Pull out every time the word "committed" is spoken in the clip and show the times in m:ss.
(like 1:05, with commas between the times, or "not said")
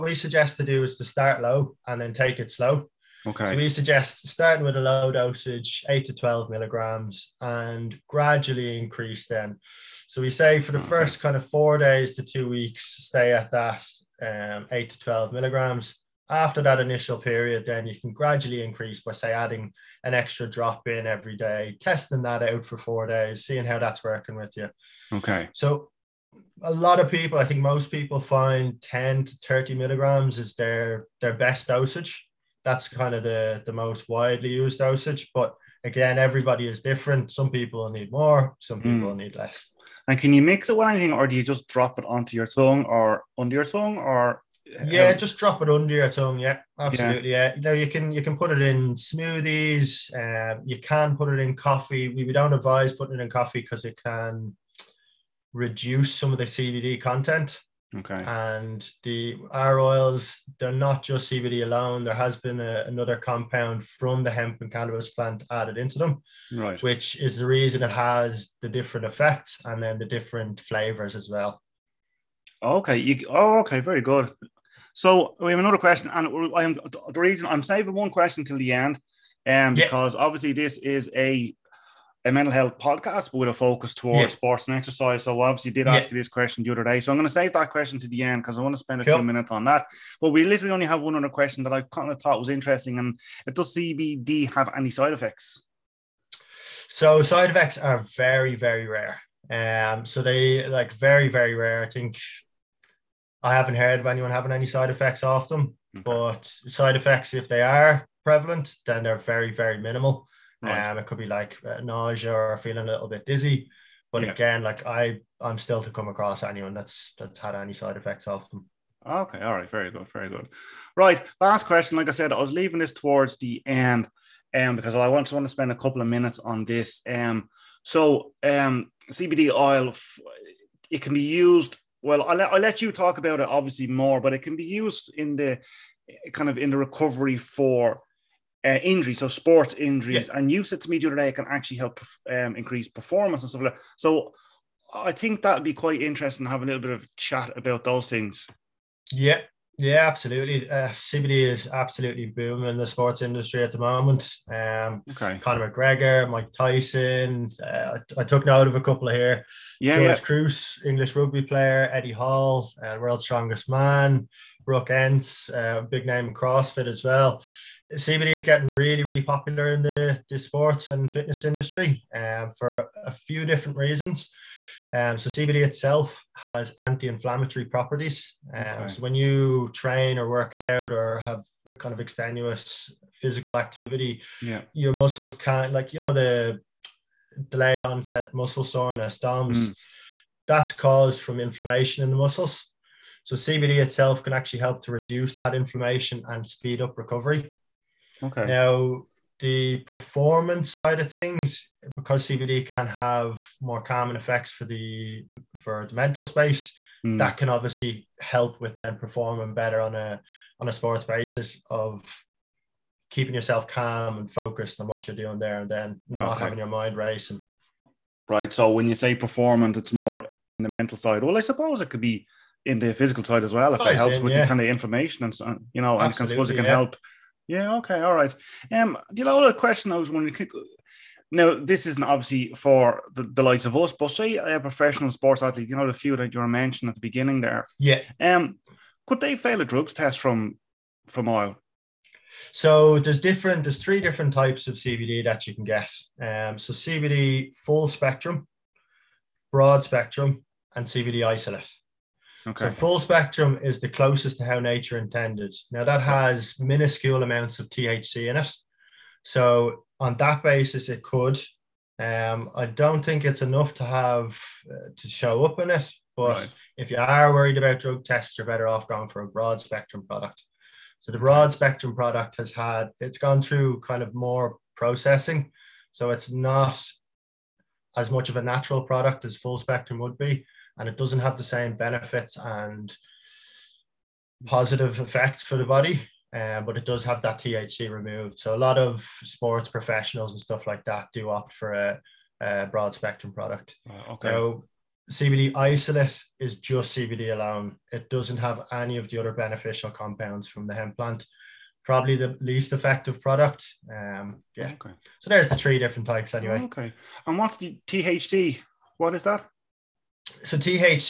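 not said.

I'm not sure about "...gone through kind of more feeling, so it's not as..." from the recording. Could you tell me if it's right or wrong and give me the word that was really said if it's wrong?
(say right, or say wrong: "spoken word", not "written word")
wrong: "processing", not "feeling".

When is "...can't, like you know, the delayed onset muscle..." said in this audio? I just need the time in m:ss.
3:05.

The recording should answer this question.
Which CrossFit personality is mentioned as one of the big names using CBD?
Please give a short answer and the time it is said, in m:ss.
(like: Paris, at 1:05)
Brooke Ence, at 2:44.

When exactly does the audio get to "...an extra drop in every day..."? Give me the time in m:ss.
0:20.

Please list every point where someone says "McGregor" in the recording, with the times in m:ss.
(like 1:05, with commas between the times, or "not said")
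2:35.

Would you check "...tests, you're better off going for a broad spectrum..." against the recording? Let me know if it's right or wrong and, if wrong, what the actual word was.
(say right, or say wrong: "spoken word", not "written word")
right.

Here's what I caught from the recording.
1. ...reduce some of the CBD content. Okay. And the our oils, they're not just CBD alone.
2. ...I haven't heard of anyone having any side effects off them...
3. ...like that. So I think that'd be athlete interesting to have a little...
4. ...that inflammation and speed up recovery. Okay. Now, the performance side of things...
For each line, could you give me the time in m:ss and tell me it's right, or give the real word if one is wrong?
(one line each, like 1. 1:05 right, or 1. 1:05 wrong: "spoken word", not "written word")
1. 0:55 right
2. 1:43 right
3. 2:23 wrong: "quite", not "athlete"
4. 3:15 right.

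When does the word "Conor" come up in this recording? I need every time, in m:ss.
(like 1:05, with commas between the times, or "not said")
2:35.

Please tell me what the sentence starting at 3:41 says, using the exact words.
Well, I suppose it could be in the physical side as well if it helps in, with yeah.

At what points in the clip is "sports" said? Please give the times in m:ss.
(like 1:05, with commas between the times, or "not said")
1:24, 2:19, 2:32, 2:50, 3:30, 3:55, 4:49.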